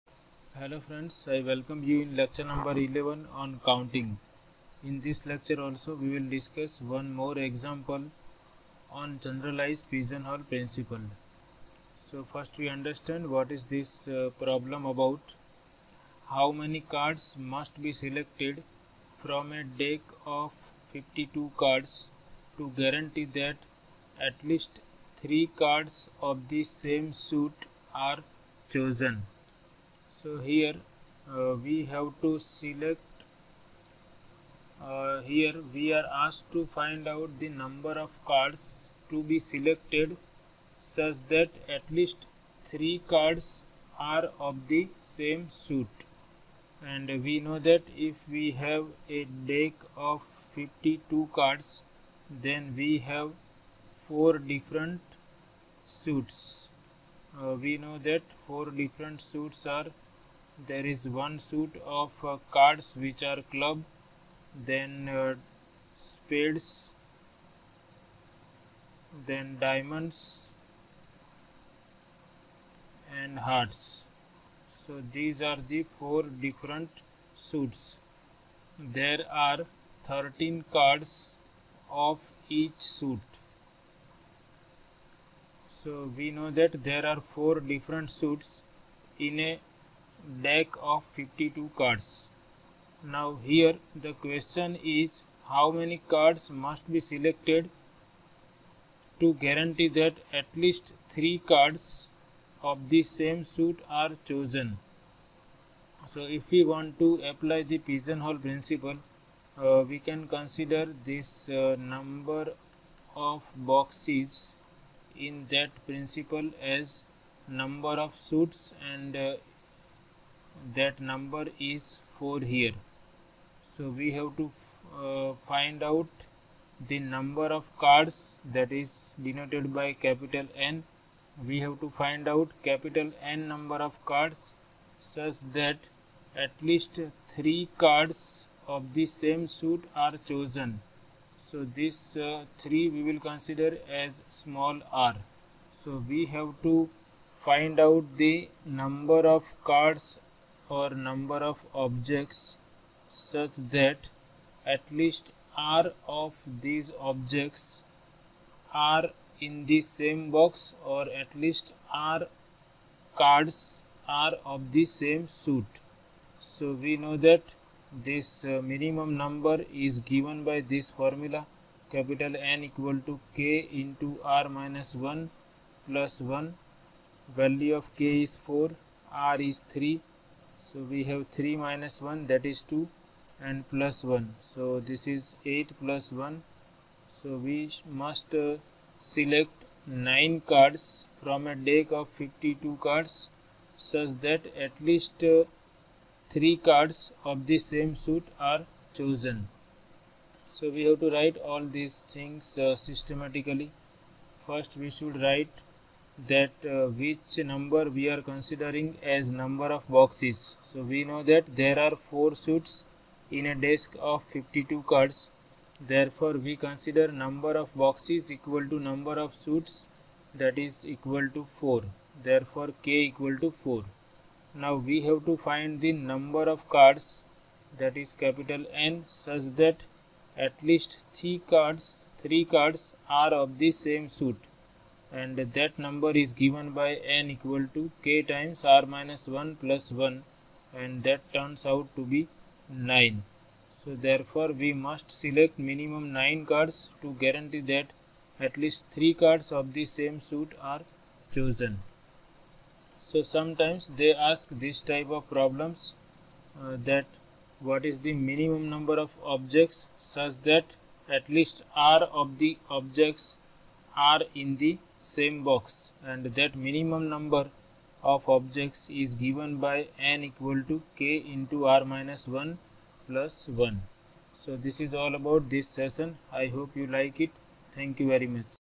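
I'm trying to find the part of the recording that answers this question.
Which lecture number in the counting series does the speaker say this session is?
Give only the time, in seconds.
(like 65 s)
2 s.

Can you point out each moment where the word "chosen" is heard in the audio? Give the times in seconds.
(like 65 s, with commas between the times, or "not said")
28 s, 104 s, 140 s, 198 s, 251 s.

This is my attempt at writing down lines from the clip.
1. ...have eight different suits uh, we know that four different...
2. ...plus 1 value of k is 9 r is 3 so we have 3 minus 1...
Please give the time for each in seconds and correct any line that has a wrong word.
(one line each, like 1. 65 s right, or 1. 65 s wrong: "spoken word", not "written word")
1. 53 s wrong: "four", not "eight"
2. 175 s wrong: "4", not "9".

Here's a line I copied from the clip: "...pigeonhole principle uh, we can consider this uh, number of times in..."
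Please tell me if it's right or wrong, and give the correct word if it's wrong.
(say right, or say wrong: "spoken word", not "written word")
wrong: "boxes", not "times".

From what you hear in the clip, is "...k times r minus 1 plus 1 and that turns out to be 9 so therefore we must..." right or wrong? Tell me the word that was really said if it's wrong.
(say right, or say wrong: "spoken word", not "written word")
right.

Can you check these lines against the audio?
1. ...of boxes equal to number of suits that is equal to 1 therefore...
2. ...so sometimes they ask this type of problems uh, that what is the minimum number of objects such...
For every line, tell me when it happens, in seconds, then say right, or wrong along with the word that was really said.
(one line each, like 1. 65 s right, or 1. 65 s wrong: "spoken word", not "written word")
1. 217 s wrong: "4", not "1"
2. 253 s right.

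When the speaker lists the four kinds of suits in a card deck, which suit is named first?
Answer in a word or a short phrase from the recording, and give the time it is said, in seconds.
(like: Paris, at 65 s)
club, at 63 s.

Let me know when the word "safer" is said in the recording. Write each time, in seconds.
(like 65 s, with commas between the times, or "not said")
not said.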